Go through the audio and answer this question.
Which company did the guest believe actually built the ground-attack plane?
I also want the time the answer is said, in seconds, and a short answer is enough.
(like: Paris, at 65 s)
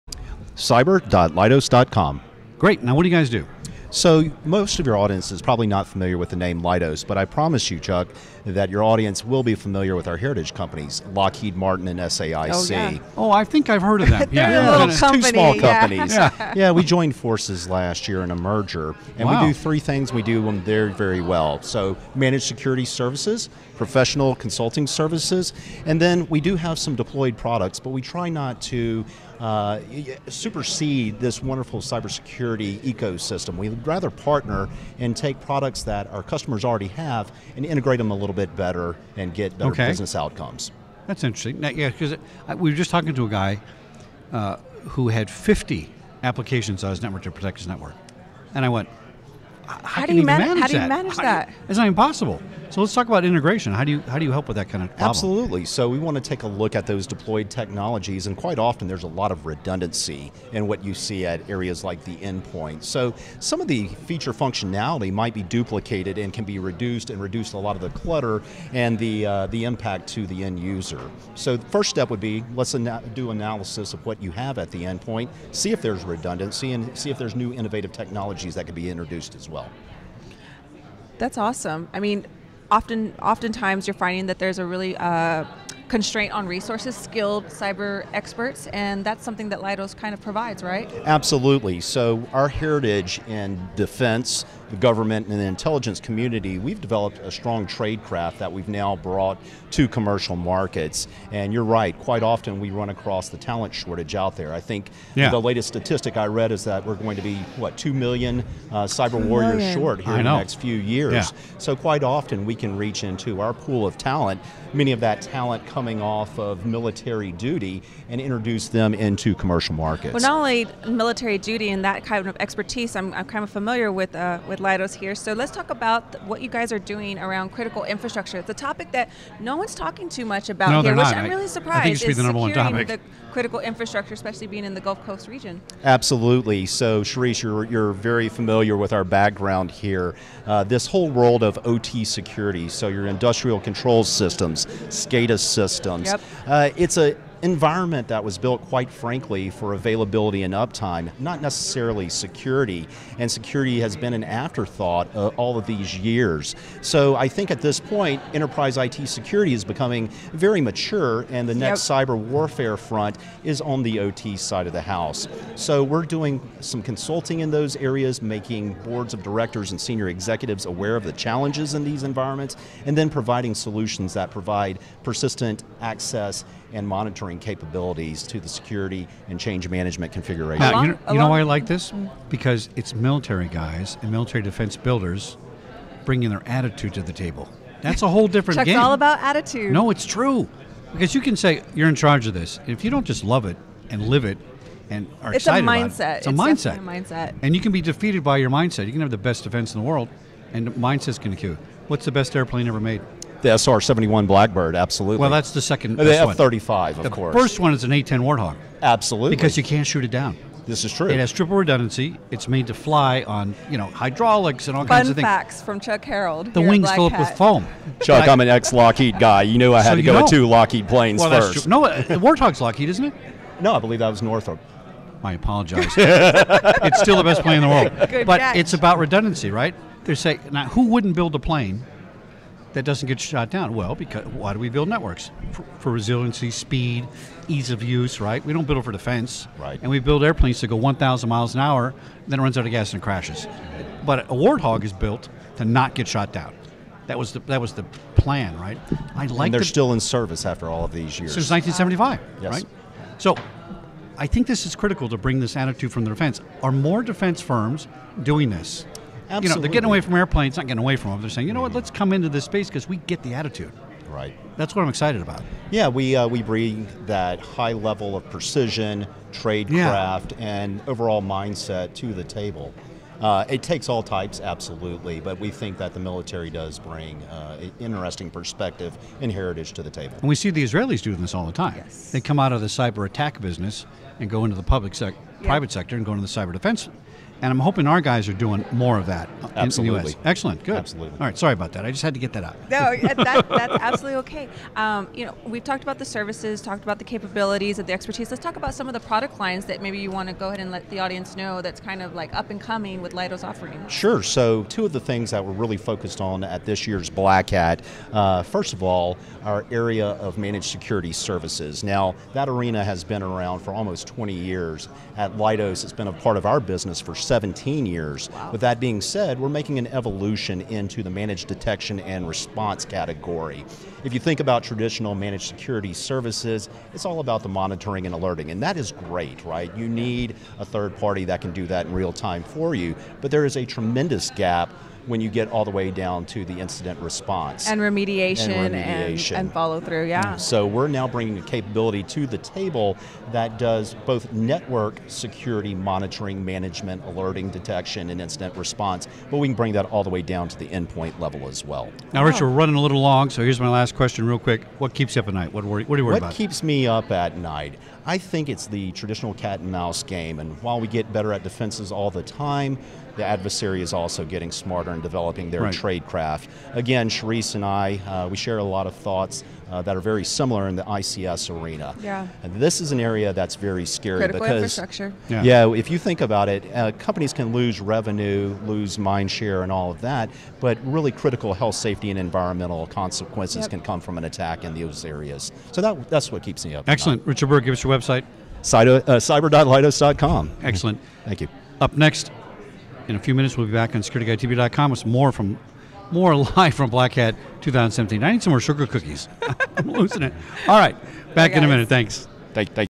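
Northrop, at 224 s.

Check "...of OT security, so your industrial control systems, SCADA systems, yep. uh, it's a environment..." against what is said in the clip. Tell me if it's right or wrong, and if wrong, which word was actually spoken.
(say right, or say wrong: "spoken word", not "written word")
right.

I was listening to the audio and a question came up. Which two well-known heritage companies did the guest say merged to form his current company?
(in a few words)
Lockheed Martin and SAIC.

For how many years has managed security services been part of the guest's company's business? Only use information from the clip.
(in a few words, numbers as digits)
17 years.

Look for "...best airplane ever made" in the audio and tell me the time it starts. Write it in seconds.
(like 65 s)
202 s.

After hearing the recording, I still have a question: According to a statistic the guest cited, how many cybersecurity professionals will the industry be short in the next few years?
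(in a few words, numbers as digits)
2 million.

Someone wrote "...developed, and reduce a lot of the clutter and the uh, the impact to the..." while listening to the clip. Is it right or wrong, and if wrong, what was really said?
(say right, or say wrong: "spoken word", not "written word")
wrong: "reduced", not "developed".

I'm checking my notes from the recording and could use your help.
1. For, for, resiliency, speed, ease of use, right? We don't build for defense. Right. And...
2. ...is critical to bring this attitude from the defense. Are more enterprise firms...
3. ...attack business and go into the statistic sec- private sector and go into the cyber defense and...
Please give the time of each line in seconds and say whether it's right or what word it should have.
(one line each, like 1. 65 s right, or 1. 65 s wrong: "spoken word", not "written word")
1. 235 s right
2. 254 s wrong: "defense", not "enterprise"
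3. 283 s wrong: "public", not "statistic".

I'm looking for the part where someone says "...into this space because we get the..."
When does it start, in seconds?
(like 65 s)
262 s.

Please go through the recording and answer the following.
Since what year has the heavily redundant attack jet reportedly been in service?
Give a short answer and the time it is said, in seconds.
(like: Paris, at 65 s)
1975, at 251 s.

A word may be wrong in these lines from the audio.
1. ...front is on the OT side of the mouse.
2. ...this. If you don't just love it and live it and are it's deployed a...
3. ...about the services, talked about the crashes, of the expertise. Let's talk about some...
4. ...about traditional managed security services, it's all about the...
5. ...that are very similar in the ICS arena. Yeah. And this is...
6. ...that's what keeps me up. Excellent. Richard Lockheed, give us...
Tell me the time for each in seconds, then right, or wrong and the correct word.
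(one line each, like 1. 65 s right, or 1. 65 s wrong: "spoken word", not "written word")
1. 162 s wrong: "house", not "mouse"
2. 192 s wrong: "excited", not "deployed"
3. 295 s wrong: "capabilities", not "crashes"
4. 324 s right
5. 369 s right
6. 386 s wrong: "Byrd", not "Lockheed".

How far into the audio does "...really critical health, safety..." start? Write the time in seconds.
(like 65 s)
380 s.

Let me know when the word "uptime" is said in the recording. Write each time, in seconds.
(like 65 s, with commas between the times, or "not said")
150 s.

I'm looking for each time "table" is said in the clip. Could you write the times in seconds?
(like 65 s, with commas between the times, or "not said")
187 s, 272 s, 279 s, 342 s.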